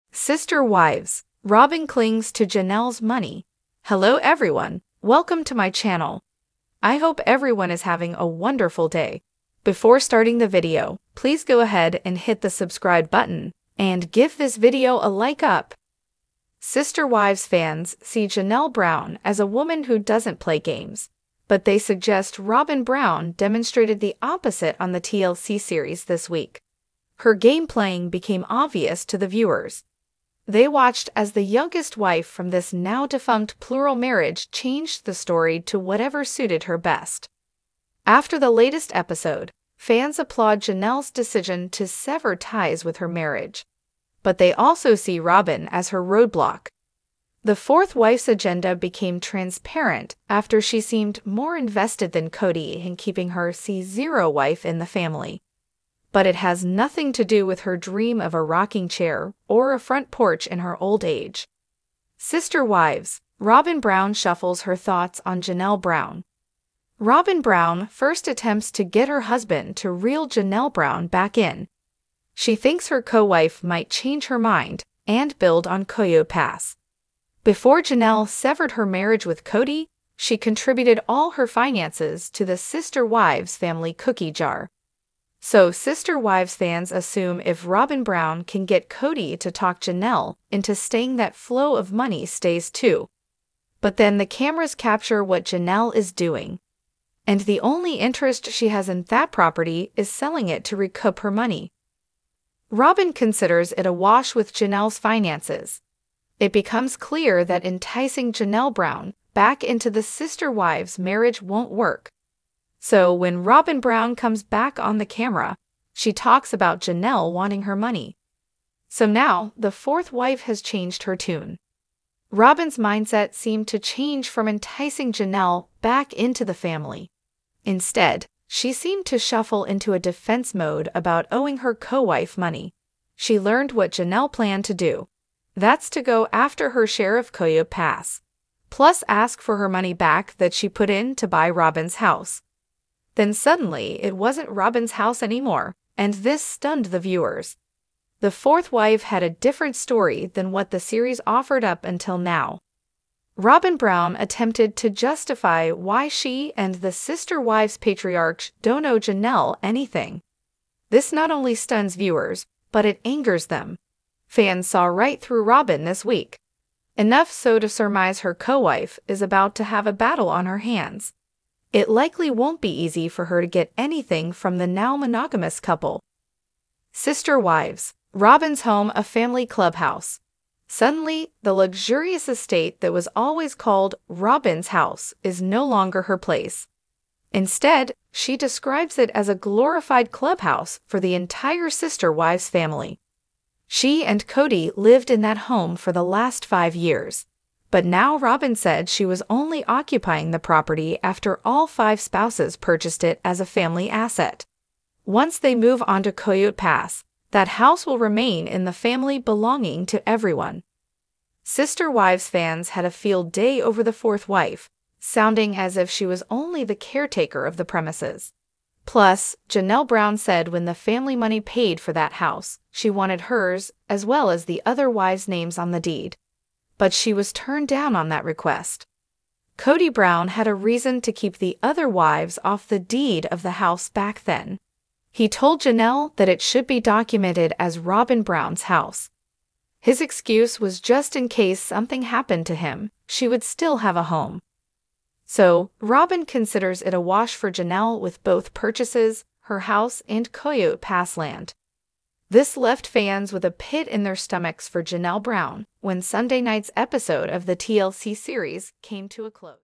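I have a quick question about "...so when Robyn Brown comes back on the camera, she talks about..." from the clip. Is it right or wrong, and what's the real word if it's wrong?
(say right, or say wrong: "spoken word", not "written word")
right.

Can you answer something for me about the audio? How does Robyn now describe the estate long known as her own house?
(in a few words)
a glorified clubhouse.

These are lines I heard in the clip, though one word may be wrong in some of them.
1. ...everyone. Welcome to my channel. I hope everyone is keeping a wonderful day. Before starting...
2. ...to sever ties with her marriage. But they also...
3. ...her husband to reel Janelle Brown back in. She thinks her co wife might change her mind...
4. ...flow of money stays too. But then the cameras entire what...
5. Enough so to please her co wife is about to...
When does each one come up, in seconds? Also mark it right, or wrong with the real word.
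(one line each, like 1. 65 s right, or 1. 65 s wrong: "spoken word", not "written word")
1. 4 s wrong: "having", not "keeping"
2. 41 s right
3. 69 s right
4. 91 s wrong: "capture", not "entire"
5. 166 s wrong: "surmise", not "please".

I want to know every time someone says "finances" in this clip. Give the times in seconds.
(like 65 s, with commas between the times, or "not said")
81 s, 104 s.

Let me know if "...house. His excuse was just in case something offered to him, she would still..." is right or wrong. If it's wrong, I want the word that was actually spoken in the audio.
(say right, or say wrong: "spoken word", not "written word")
wrong: "happened", not "offered".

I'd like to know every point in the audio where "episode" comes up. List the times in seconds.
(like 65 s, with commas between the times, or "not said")
38 s, 256 s.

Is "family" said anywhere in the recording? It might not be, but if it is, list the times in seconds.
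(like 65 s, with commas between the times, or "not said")
54 s, 83 s, 126 s, 179 s, 192 s, 203 s, 208 s, 220 s.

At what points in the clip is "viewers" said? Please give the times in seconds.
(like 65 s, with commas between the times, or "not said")
29 s, 146 s, 161 s.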